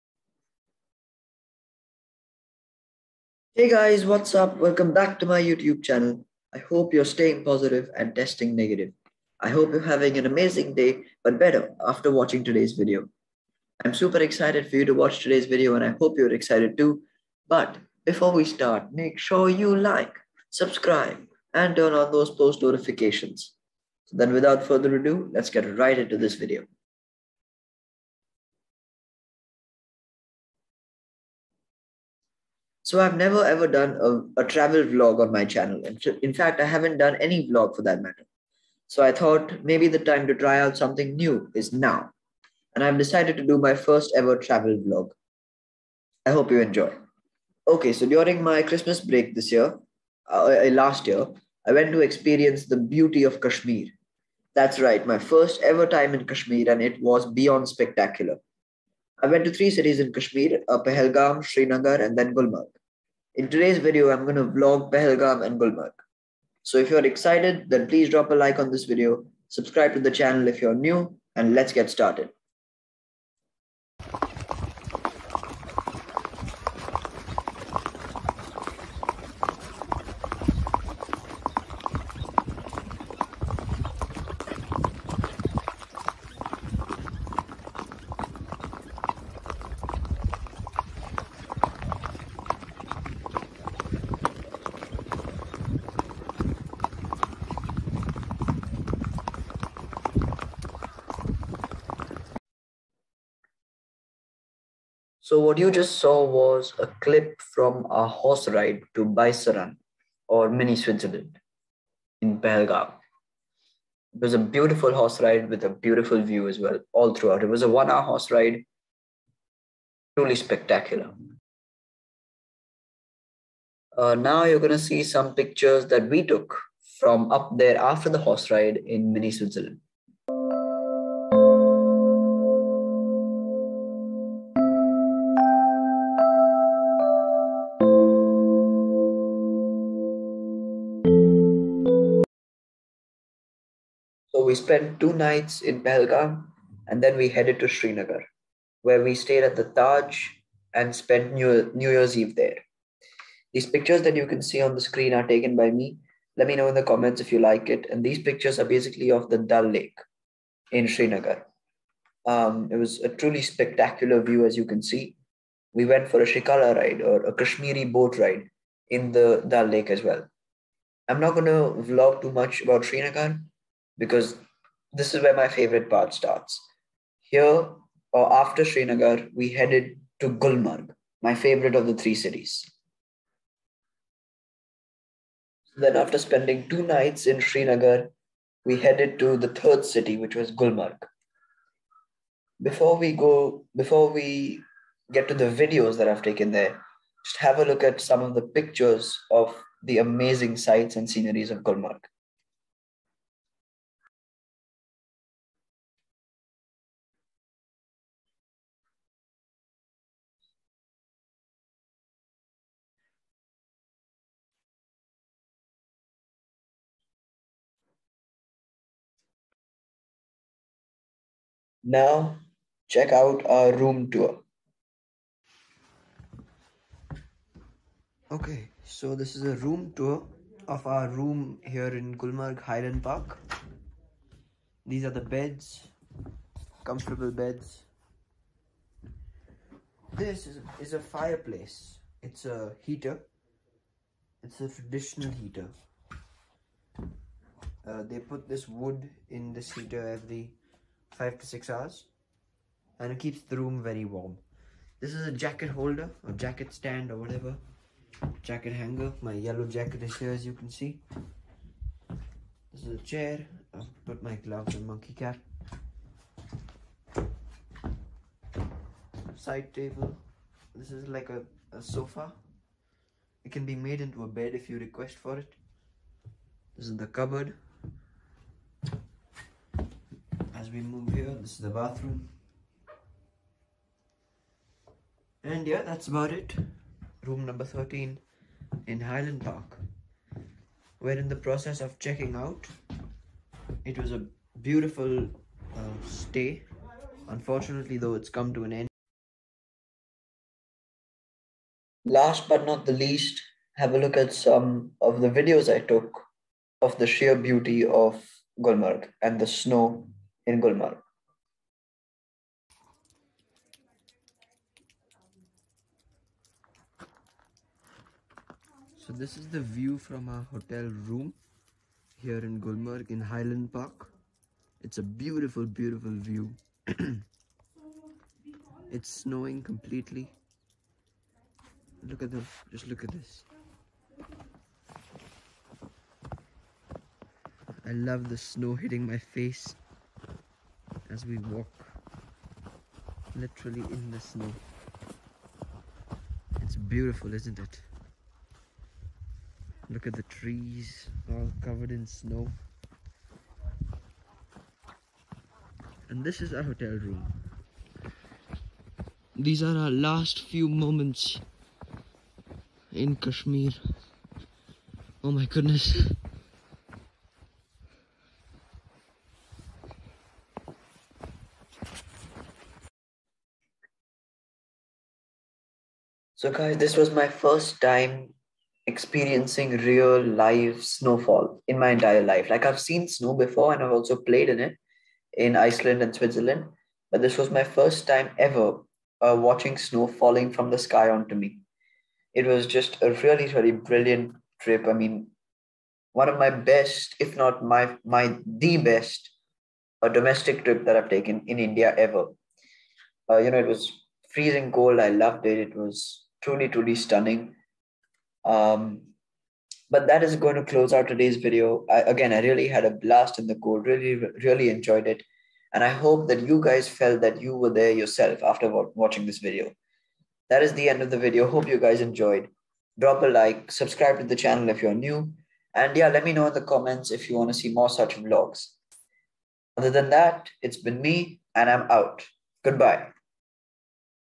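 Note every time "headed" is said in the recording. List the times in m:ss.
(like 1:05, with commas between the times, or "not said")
2:27, 2:59, 3:08.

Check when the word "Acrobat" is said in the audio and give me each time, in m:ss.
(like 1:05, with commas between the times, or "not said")
not said.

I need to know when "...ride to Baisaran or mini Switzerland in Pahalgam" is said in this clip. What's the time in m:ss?
1:48.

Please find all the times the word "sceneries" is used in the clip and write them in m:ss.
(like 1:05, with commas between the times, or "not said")
3:21.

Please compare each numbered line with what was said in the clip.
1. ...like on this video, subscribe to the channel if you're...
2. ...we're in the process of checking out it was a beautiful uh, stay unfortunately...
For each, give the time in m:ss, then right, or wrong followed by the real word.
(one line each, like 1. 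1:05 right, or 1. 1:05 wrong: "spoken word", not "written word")
1. 1:08 right
2. 4:50 right.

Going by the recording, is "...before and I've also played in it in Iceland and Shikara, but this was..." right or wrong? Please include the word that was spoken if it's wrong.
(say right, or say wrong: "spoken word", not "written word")
wrong: "Switzerland", not "Shikara".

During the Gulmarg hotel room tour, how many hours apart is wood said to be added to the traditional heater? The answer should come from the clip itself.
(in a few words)
5 to 6 hours.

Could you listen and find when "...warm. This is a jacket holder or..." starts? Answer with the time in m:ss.
4:14.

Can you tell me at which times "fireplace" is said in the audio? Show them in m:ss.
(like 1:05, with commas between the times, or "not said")
4:00.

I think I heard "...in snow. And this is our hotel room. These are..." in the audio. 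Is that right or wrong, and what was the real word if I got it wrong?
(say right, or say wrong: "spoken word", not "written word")
right.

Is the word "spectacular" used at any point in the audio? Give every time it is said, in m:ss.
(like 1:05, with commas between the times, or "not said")
0:57, 2:00, 2:43.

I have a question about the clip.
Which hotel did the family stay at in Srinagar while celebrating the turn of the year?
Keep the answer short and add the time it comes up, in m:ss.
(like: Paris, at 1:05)
The Taj, at 2:29.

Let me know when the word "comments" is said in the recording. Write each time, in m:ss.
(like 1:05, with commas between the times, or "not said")
2:36, 7:06.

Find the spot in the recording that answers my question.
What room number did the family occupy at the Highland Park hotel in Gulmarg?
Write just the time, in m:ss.
4:47.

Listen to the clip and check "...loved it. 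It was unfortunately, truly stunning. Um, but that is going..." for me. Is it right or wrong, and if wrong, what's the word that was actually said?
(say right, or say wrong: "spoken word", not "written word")
wrong: "truly", not "unfortunately".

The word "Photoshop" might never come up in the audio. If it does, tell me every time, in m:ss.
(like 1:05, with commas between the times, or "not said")
not said.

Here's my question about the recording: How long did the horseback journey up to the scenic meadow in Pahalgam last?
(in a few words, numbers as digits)
One hour.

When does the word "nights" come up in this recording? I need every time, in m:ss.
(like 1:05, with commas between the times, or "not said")
2:25, 3:06.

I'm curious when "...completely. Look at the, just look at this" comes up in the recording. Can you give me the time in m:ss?
5:29.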